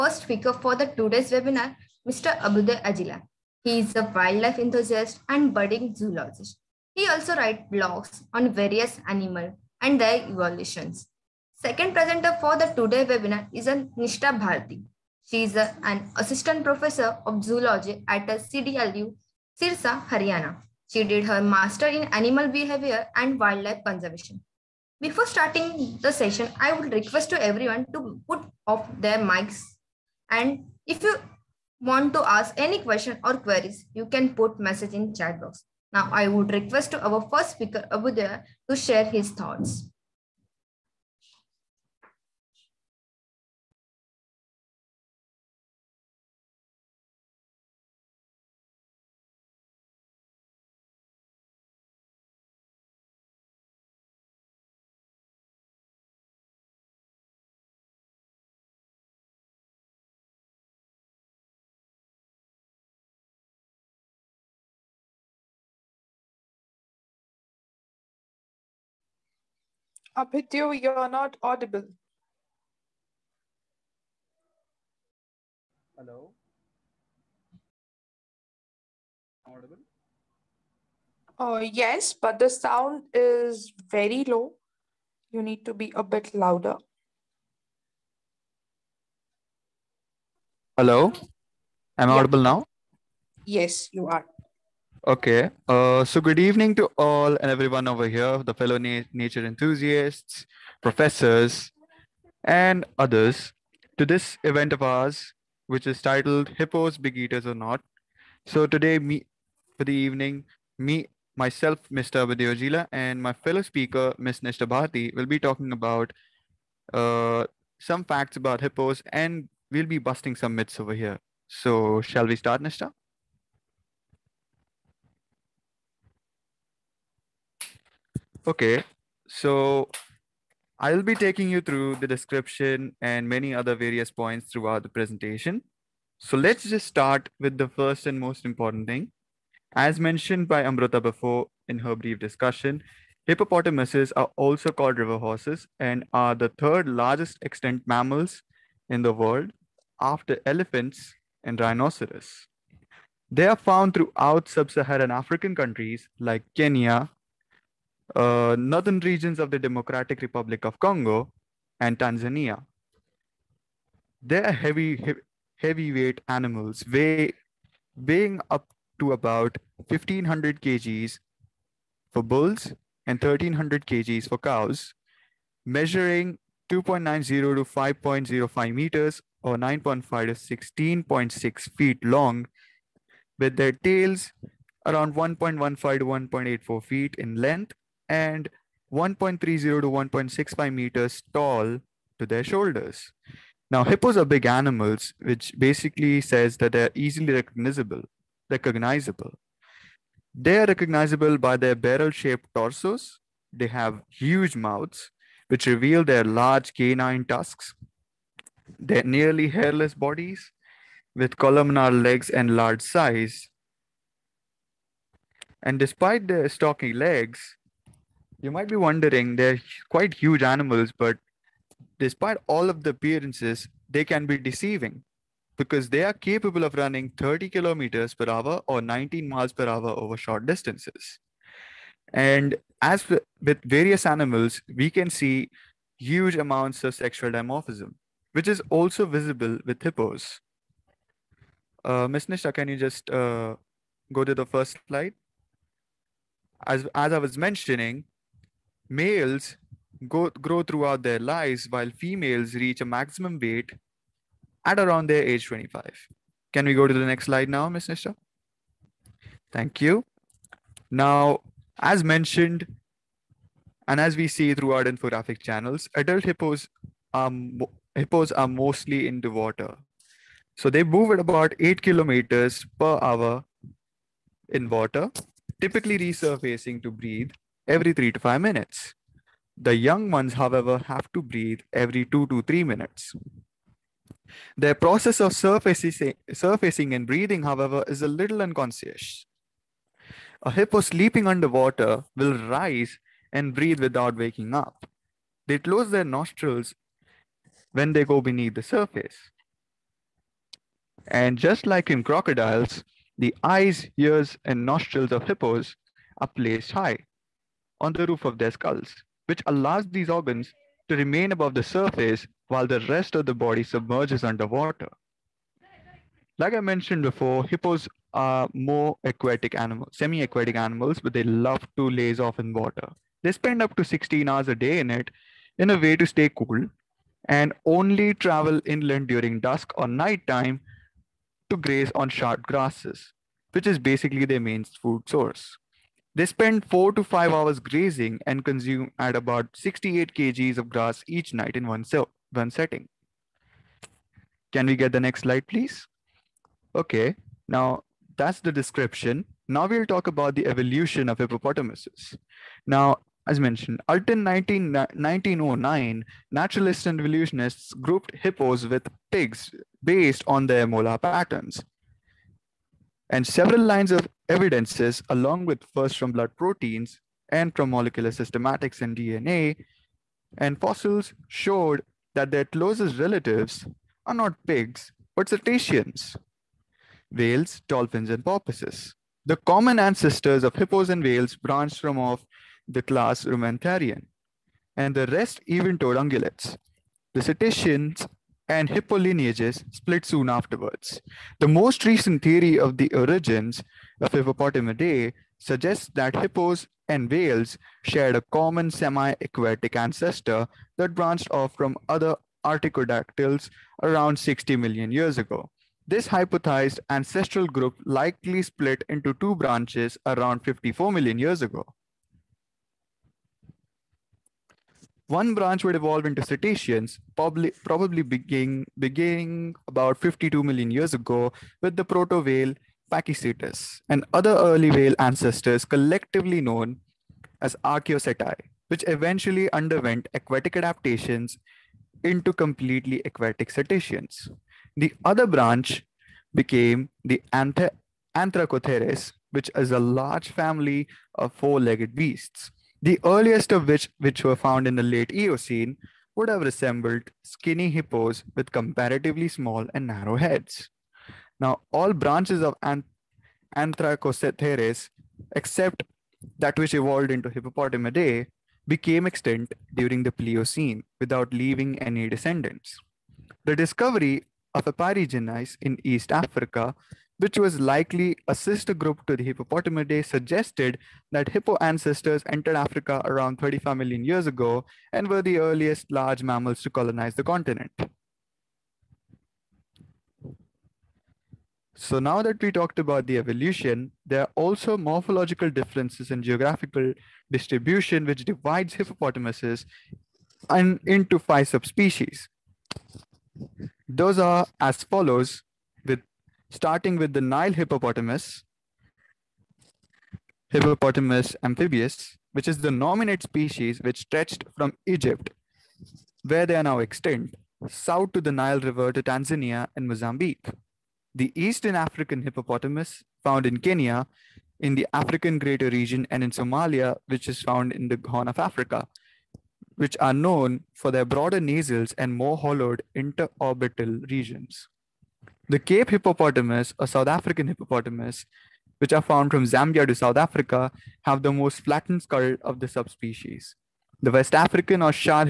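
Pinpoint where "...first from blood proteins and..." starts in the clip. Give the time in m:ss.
6:05.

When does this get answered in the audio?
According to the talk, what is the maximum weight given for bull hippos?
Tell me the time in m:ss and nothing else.
2:49.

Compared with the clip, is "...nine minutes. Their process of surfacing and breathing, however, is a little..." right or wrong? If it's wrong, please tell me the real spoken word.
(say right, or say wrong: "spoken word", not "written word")
wrong: "three", not "nine".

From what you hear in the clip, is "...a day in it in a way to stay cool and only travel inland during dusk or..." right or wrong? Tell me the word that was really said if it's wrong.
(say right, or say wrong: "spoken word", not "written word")
right.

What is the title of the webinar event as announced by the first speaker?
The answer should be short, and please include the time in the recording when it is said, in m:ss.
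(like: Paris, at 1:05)
Hippos Big Eaters or Not, at 1:46.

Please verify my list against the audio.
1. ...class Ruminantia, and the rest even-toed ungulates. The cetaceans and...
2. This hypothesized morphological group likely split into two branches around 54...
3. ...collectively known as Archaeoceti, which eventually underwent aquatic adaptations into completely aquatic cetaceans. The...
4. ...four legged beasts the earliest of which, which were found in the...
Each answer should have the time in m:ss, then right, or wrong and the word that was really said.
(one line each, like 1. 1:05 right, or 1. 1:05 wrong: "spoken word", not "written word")
1. 6:22 right
2. 6:45 wrong: "ancestral", not "morphological"
3. 7:05 right
4. 7:21 right.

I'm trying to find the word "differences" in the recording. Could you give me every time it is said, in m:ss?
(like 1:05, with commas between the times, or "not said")
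8:05.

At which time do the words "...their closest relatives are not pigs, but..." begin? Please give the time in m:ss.
6:12.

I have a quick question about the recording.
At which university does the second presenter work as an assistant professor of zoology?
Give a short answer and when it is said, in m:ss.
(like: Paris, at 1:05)
CDLU, Sirsa, at 0:18.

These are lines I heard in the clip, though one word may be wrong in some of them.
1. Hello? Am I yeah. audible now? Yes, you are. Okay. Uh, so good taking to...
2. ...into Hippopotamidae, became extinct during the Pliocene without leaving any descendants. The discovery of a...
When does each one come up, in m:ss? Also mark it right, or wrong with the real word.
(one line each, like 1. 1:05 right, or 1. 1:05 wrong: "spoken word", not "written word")
1. 1:30 wrong: "evening", not "taking"
2. 7:37 right.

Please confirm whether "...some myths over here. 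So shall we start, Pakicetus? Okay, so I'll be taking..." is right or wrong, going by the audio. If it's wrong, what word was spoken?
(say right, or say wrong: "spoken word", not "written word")
wrong: "Nishtha", not "Pakicetus".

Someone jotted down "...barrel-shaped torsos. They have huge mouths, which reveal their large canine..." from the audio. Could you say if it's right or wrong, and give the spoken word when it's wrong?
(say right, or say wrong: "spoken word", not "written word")
right.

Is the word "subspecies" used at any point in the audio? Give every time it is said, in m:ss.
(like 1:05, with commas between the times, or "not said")
8:11, 8:52.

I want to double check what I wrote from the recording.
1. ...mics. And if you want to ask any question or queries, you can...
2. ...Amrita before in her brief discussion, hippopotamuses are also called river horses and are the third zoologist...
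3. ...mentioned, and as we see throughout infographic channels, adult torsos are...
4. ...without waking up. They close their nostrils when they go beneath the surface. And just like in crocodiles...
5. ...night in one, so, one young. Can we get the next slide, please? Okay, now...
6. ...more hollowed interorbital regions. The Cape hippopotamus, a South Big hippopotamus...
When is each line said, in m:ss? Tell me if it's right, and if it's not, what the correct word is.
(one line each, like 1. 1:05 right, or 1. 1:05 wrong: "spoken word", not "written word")
1. 0:29 right
2. 2:20 wrong: "largest", not "zoologist"
3. 4:22 wrong: "hippos", not "torsos"
4. 4:53 right
5. 5:41 wrong: "setting", not "young"
6. 8:42 wrong: "African", not "Big".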